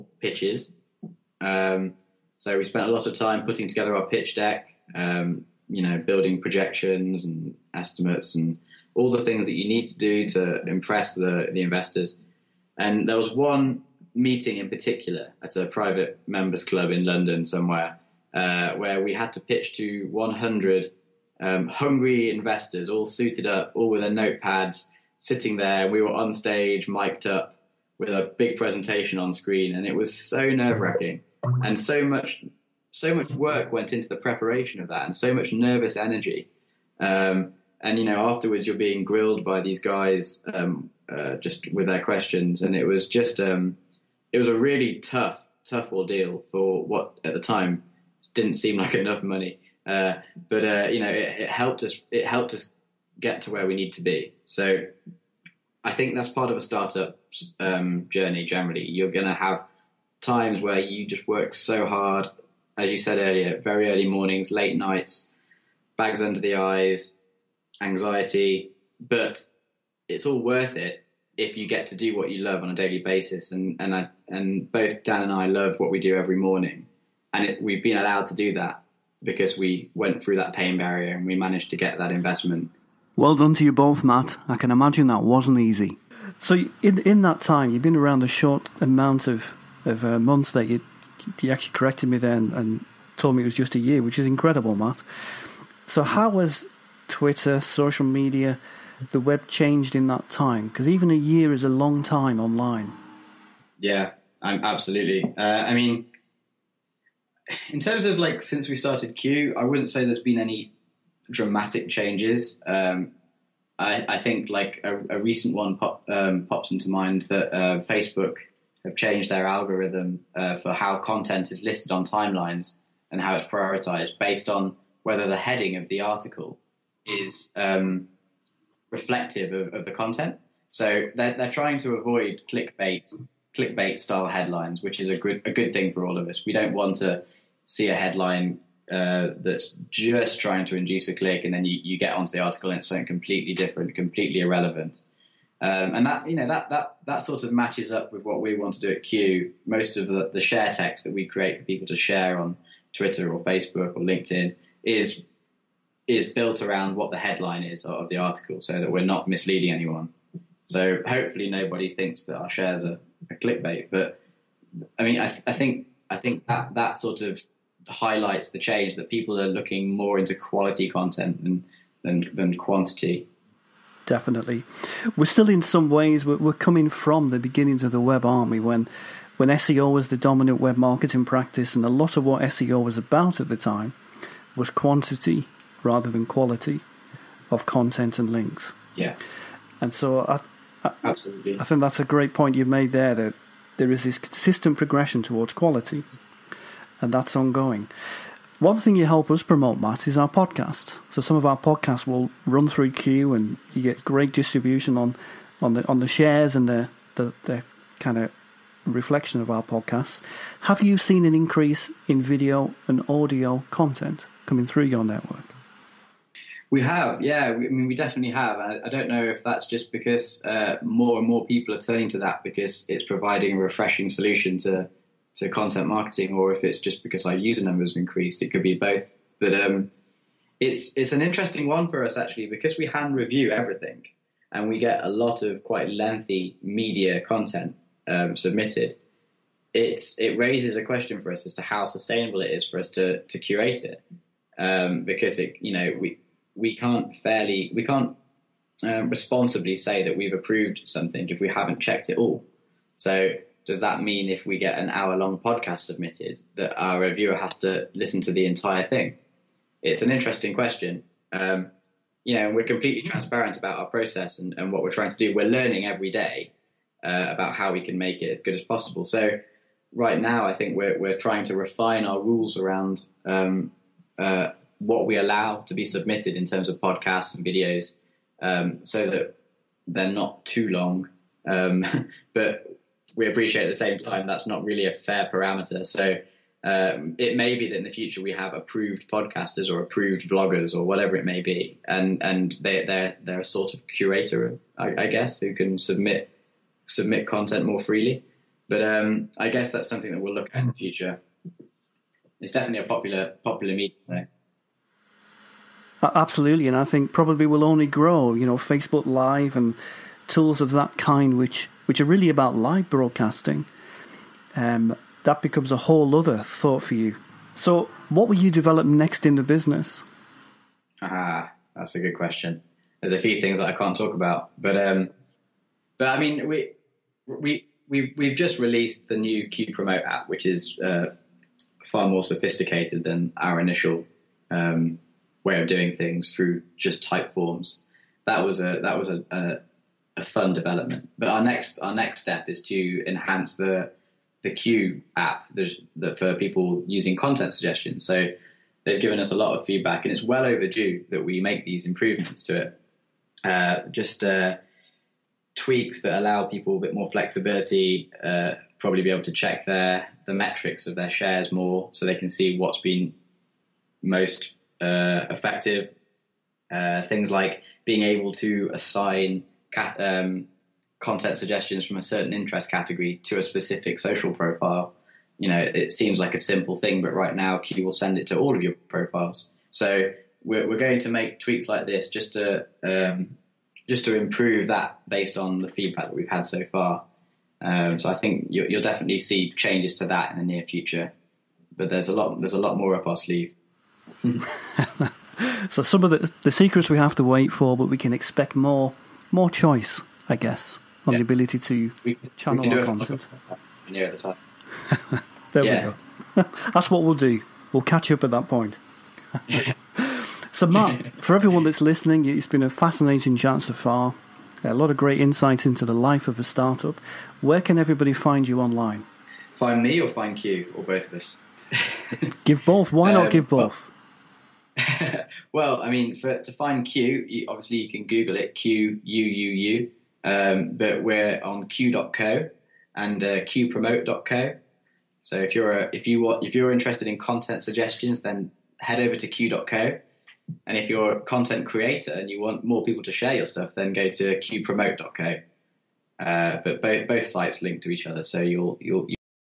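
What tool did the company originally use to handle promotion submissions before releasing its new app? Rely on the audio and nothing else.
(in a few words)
Typeforms.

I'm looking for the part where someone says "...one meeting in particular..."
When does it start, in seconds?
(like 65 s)
13 s.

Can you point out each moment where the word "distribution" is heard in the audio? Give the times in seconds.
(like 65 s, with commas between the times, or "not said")
204 s.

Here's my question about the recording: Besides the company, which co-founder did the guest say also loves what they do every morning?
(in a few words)
Dan.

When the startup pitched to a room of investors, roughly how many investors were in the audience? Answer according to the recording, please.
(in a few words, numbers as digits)
100.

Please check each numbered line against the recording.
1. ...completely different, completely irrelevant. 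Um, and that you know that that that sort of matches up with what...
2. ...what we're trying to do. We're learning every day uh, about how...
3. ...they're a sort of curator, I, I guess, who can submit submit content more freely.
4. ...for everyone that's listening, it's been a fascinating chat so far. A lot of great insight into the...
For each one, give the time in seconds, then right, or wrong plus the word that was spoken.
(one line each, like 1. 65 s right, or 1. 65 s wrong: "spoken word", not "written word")
1. 143 s right
2. 264 s right
3. 293 s right
4. 411 s right.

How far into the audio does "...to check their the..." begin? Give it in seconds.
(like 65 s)
359 s.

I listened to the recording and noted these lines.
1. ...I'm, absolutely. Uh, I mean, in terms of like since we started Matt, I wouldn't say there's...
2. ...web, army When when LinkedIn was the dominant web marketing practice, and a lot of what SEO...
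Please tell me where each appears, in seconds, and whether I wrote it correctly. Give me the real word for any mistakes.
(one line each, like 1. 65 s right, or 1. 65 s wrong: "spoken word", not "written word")
1. 104 s wrong: "Quuu", not "Matt"
2. 177 s wrong: "SEO", not "LinkedIn".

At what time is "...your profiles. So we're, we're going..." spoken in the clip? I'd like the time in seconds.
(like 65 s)
378 s.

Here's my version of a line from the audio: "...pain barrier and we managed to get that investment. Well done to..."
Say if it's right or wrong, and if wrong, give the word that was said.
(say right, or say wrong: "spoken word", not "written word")
right.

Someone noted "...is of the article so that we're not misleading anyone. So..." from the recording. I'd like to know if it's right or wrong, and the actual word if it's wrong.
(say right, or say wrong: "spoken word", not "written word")
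right.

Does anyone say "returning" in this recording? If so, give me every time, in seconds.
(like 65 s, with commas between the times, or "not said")
not said.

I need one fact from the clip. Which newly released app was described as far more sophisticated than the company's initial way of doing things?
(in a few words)
Quuu Promote.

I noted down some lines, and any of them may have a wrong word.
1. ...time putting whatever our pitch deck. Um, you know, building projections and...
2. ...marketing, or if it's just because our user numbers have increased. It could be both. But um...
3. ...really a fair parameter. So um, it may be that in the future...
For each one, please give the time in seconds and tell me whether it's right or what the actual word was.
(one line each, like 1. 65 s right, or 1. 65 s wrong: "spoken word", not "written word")
1. 3 s wrong: "together", not "whatever"
2. 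225 s right
3. 284 s right.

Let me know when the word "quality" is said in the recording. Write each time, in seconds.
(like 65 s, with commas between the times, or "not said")
170 s, 186 s, 195 s.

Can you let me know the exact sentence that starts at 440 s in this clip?
And if you're a content creator and you want more people to share your stuff, then go to Quuupromote.co.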